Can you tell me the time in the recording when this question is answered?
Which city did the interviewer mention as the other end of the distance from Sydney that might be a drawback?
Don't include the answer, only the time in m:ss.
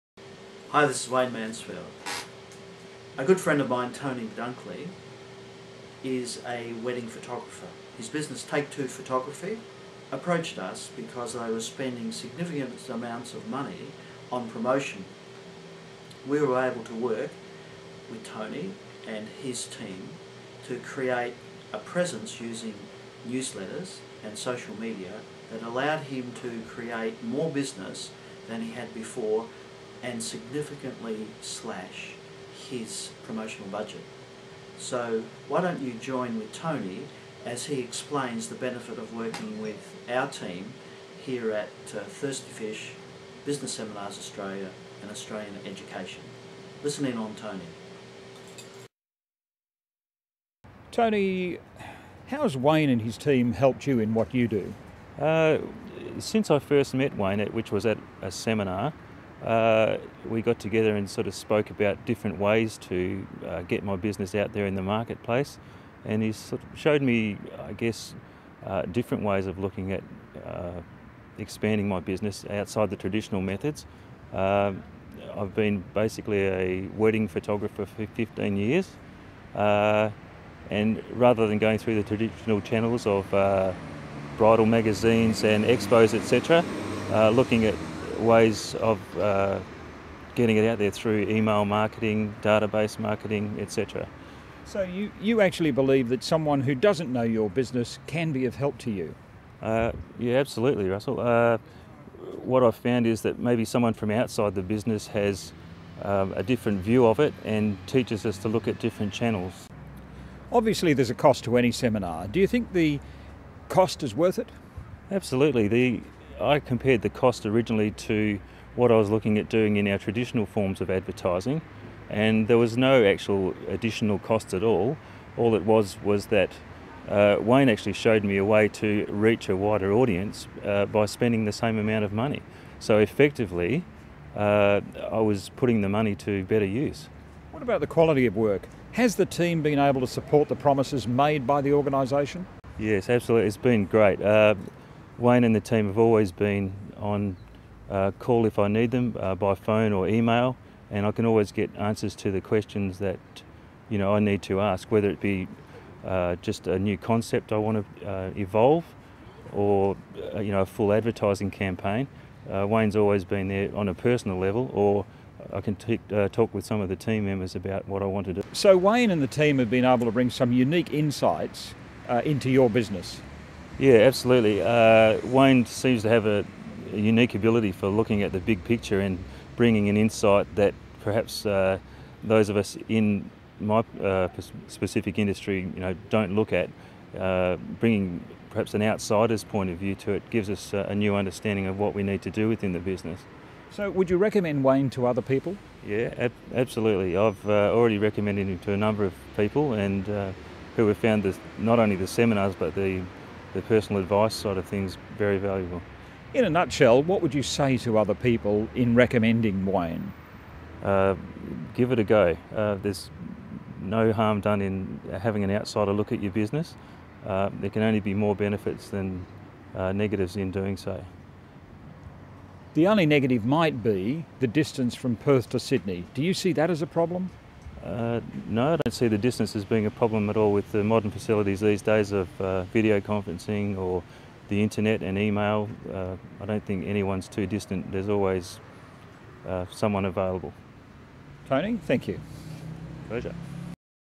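3:45.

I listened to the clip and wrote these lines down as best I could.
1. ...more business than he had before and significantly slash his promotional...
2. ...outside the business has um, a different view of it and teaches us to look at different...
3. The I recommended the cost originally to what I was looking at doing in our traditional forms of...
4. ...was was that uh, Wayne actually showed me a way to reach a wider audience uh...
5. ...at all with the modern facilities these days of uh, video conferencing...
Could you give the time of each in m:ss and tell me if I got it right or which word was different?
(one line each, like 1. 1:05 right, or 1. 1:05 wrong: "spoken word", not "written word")
1. 0:27 right
2. 1:44 right
3. 1:55 wrong: "compared", not "recommended"
4. 2:05 right
5. 3:50 right.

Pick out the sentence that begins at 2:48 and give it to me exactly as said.
So Wayne and the team have been able to bring some unique insights uh, into your business.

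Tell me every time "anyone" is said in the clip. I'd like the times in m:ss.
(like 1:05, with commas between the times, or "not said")
3:56.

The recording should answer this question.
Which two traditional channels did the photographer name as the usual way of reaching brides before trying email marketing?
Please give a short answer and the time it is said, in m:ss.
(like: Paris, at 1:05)
Bridal magazines and expos, at 1:24.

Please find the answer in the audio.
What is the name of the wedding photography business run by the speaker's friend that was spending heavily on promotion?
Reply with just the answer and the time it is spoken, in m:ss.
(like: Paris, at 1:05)
Take Two Photography, at 0:08.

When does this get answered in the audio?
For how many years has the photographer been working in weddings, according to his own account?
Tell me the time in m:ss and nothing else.
1:18.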